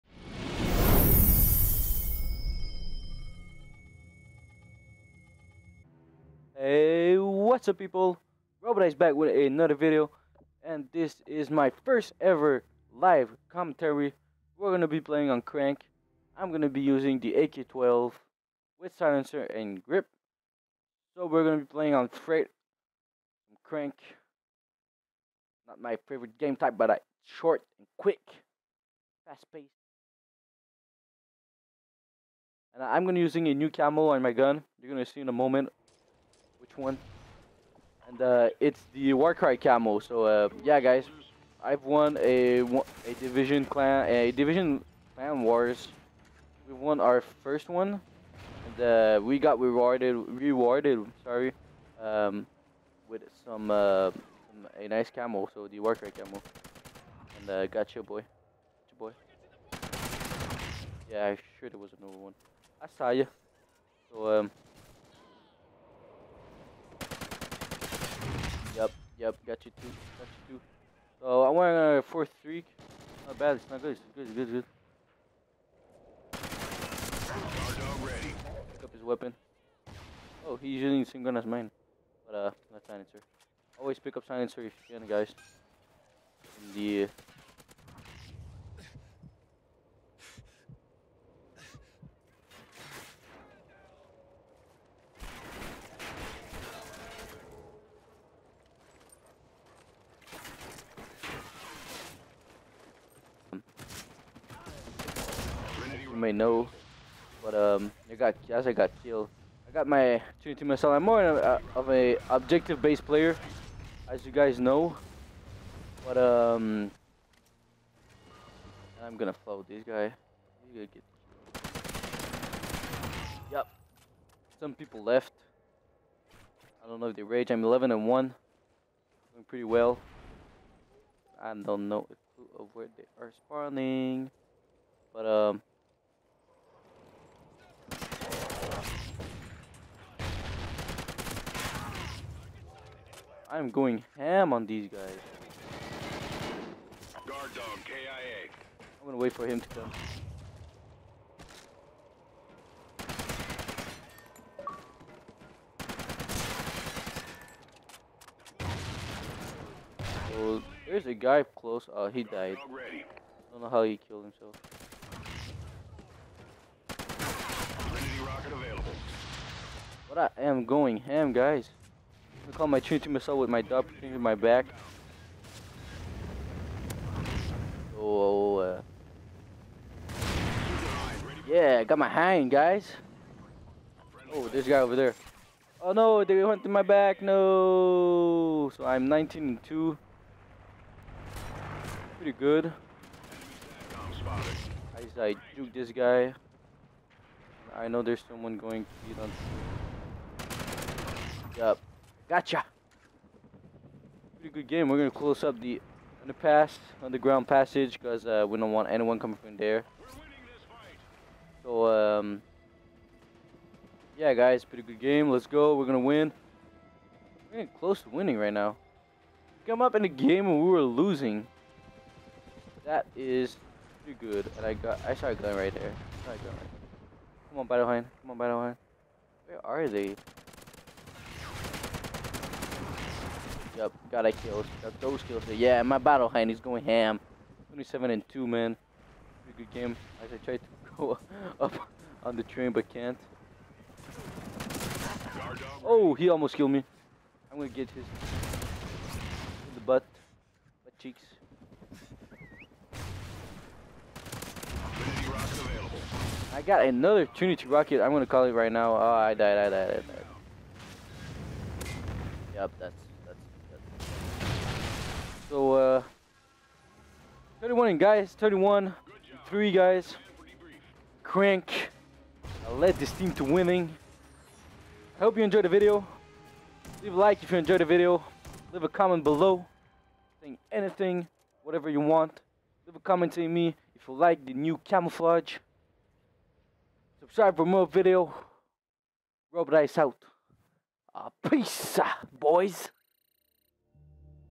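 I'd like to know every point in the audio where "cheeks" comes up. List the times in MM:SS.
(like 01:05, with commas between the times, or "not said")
04:10.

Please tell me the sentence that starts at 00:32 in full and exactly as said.
And I'm gonna be using a new camo on my gun.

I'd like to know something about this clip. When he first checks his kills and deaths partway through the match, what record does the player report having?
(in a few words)
11 and 1.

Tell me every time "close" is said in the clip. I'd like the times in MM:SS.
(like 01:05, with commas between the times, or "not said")
02:41, 03:25, 03:37.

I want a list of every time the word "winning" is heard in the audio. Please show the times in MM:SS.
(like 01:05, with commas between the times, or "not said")
03:38, 04:33.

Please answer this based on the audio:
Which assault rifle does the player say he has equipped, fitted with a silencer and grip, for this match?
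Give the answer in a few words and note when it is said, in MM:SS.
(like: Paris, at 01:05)
AK-12, at 00:17.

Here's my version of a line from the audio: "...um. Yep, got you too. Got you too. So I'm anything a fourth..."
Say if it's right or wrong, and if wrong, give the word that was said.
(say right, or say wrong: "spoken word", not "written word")
wrong: "wearing", not "anything".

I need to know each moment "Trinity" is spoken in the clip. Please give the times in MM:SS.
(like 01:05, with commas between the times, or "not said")
02:52, 04:17.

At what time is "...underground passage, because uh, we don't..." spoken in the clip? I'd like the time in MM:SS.
03:27.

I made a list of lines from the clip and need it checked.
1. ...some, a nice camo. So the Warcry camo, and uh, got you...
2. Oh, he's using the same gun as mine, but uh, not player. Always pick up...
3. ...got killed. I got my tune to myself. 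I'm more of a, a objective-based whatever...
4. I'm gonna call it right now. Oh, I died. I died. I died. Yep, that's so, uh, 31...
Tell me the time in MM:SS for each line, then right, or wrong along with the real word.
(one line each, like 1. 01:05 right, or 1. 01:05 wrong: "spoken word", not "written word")
1. 00:54 right
2. 01:20 wrong: "silencer", not "player"
3. 01:48 wrong: "player", not "whatever"
4. 04:18 right.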